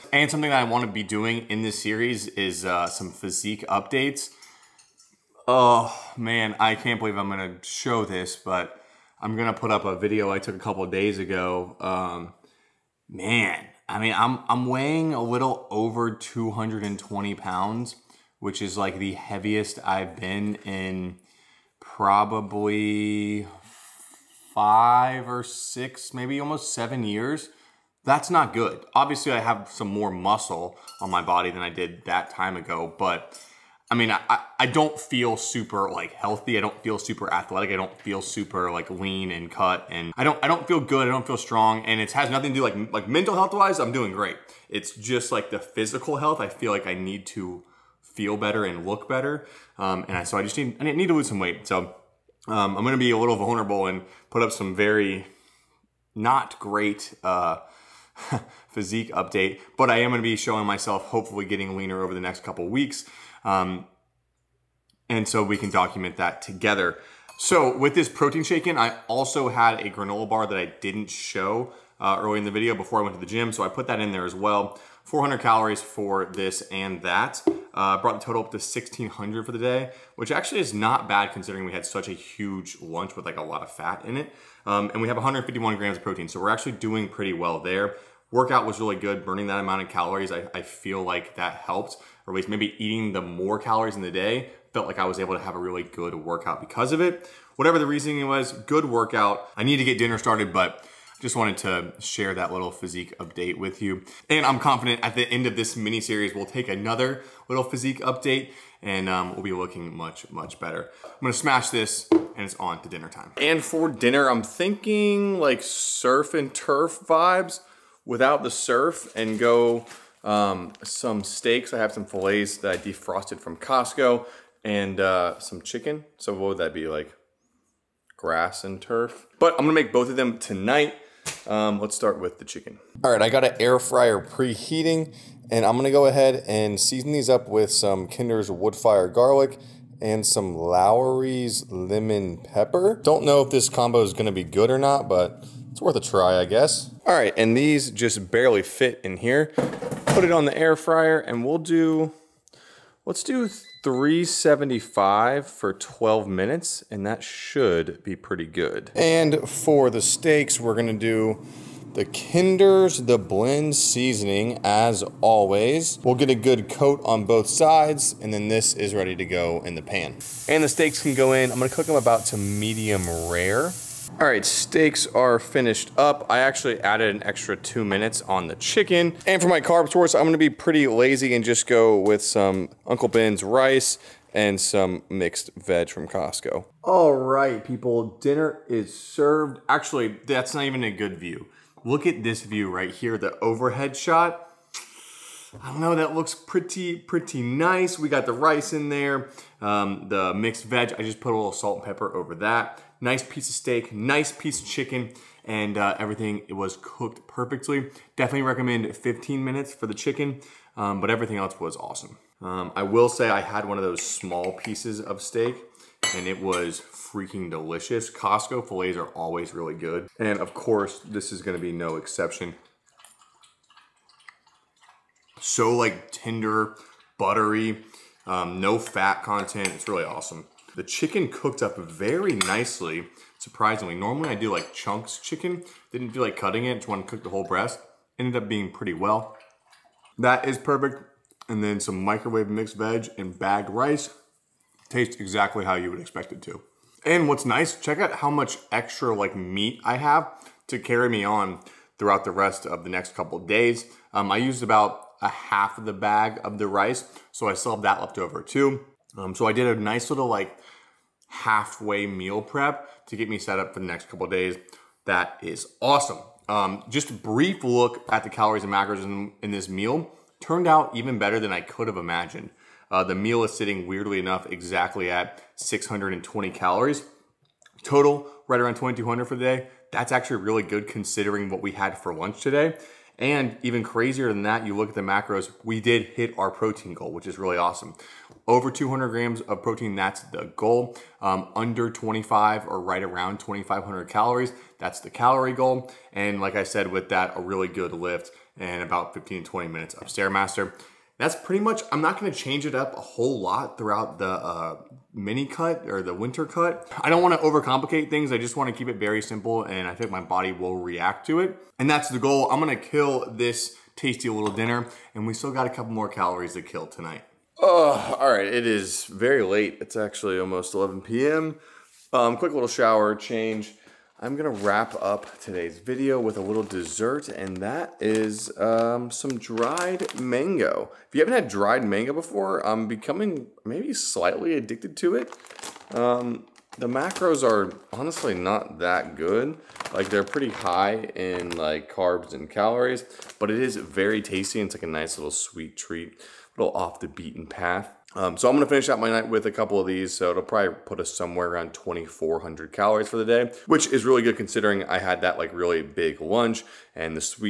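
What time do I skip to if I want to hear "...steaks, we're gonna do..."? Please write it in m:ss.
2:39.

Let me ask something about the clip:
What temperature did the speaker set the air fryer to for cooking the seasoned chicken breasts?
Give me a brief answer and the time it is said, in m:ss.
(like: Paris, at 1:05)
375, at 2:33.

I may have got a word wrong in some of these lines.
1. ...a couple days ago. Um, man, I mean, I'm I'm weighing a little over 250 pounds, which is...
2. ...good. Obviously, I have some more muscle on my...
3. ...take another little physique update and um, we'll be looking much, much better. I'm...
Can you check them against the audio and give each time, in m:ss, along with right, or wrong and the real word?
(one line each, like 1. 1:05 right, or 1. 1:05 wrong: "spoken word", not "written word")
1. 0:10 wrong: "220", not "250"
2. 0:28 right
3. 1:46 right.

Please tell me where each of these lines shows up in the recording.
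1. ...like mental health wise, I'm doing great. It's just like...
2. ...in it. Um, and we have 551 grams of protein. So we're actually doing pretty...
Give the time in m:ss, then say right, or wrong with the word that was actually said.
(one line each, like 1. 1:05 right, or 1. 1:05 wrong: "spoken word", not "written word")
1. 0:42 right
2. 1:24 wrong: "151", not "551".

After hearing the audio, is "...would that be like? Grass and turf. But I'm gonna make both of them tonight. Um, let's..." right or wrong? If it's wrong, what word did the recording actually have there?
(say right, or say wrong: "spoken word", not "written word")
right.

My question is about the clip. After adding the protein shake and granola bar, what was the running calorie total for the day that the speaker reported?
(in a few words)
1600.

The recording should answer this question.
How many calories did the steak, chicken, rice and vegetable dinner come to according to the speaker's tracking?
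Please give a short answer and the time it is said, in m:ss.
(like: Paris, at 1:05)
620, at 4:35.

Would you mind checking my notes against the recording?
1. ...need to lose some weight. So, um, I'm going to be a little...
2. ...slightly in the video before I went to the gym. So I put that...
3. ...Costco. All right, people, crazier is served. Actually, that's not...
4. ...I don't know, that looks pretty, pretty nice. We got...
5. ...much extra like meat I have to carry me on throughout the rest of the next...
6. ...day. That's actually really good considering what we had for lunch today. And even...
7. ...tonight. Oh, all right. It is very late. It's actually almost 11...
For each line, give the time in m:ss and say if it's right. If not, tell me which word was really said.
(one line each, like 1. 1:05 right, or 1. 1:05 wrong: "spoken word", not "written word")
1. 0:50 right
2. 1:12 wrong: "early", not "slightly"
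3. 3:06 wrong: "dinner", not "crazier"
4. 3:15 right
5. 4:08 right
6. 4:39 right
7. 5:16 right.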